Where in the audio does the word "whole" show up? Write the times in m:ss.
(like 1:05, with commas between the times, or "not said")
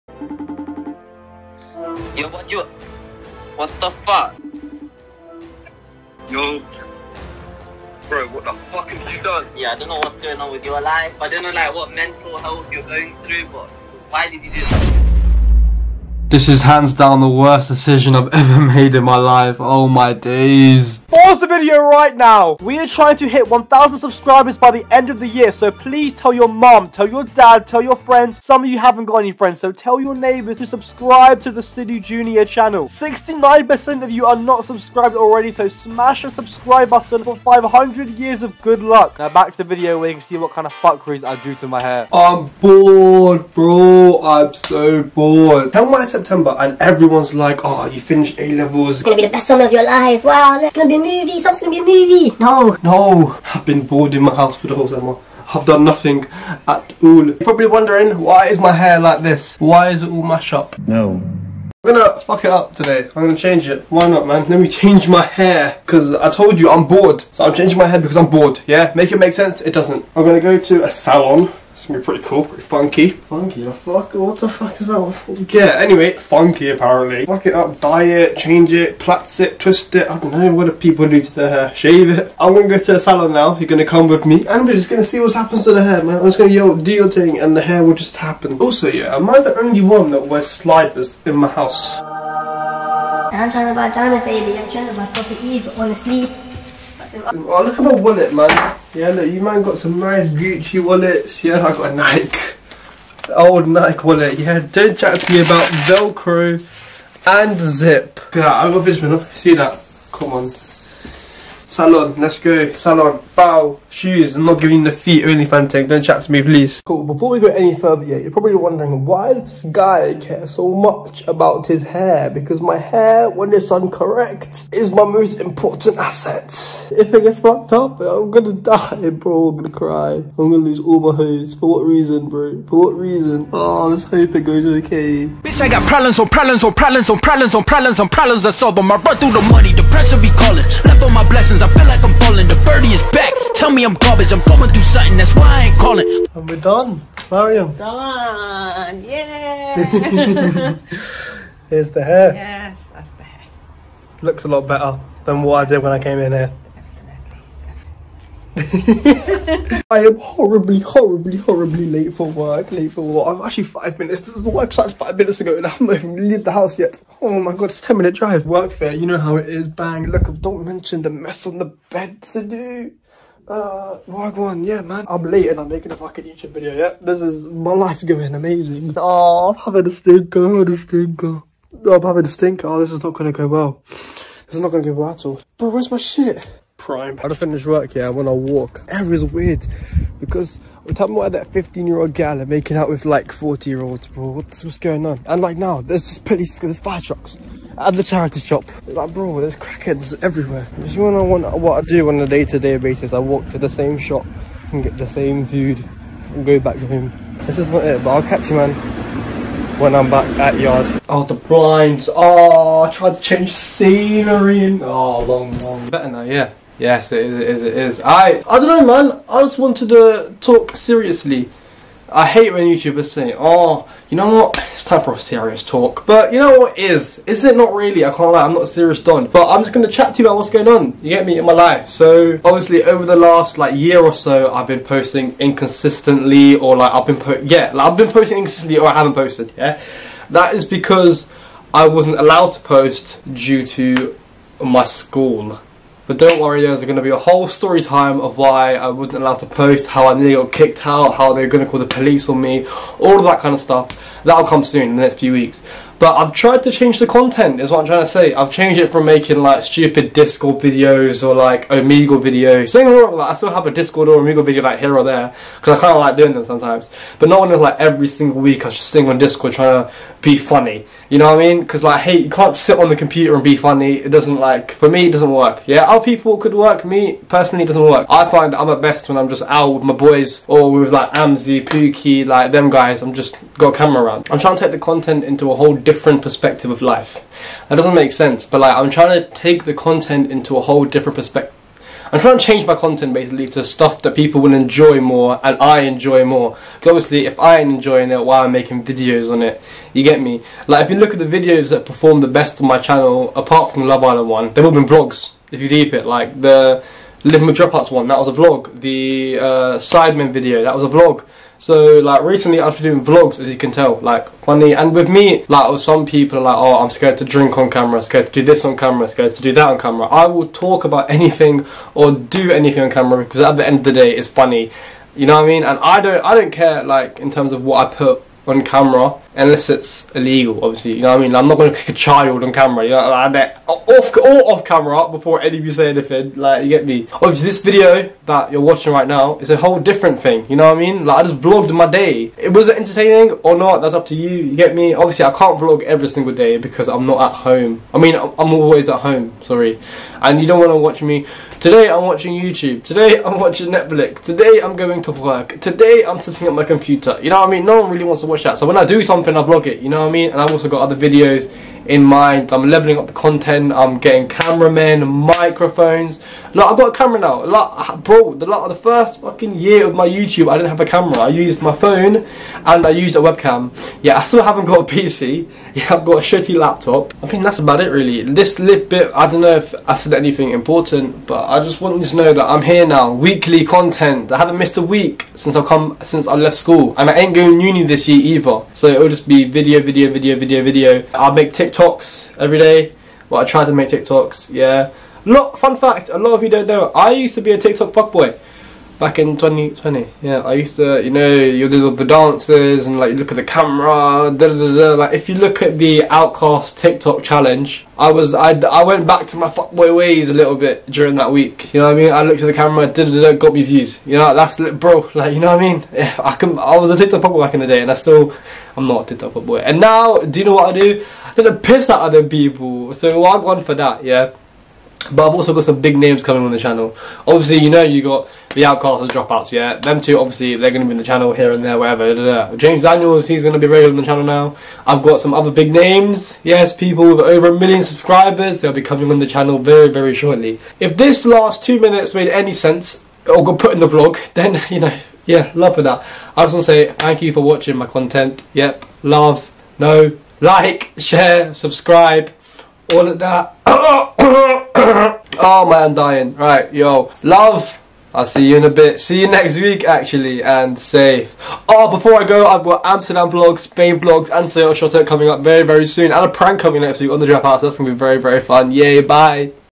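0:54, 4:07, 4:45, 4:50, 5:39.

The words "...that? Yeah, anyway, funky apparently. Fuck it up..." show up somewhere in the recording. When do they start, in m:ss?
1:14.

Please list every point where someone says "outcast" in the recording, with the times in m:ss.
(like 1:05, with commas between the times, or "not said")
6:46, 7:08.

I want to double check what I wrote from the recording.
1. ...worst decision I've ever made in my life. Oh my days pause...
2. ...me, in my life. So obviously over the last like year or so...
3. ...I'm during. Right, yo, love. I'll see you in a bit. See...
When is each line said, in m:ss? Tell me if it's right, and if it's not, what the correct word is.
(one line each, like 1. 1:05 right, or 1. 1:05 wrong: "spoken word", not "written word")
1. 0:17 right
2. 3:51 right
3. 7:35 wrong: "dying", not "during".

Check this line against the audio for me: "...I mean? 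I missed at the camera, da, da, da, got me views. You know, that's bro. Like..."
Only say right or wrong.
wrong.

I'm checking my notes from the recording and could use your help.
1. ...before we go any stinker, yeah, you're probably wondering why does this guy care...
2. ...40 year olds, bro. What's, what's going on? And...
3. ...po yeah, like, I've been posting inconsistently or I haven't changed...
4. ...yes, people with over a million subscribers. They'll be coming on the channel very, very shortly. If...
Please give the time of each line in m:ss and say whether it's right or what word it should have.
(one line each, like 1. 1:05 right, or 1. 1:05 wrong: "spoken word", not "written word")
1. 1:57 wrong: "further", not "stinker"
2. 3:13 right
3. 3:57 wrong: "posted", not "changed"
4. 7:16 right.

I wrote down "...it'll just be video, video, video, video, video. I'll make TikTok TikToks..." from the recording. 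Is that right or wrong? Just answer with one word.
right.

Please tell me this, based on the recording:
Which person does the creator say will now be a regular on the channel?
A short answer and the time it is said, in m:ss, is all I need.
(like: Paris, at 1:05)
James Daniels, at 7:12.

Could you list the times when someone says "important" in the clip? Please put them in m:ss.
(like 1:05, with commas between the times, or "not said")
2:05, 6:20.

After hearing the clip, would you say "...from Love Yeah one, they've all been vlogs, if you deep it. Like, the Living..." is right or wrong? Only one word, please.
wrong.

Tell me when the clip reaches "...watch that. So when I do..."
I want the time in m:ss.
5:58.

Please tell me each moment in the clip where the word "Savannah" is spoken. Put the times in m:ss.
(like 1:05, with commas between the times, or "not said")
not said.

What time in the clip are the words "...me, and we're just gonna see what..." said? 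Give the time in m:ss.
1:24.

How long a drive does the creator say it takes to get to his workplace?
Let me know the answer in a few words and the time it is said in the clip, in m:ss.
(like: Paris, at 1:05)
10 minutes, at 2:47.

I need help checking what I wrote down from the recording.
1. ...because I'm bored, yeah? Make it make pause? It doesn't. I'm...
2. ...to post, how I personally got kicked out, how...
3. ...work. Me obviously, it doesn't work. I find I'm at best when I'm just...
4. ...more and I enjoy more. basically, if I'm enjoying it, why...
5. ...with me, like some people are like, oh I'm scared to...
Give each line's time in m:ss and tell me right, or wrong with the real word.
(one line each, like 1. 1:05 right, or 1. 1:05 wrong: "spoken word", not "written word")
1. 1:07 wrong: "sense", not "pause"
2. 4:09 wrong: "nearly", not "personally"
3. 4:36 wrong: "personally", not "obviously"
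4. 4:55 wrong: "obviously", not "basically"
5. 5:14 right.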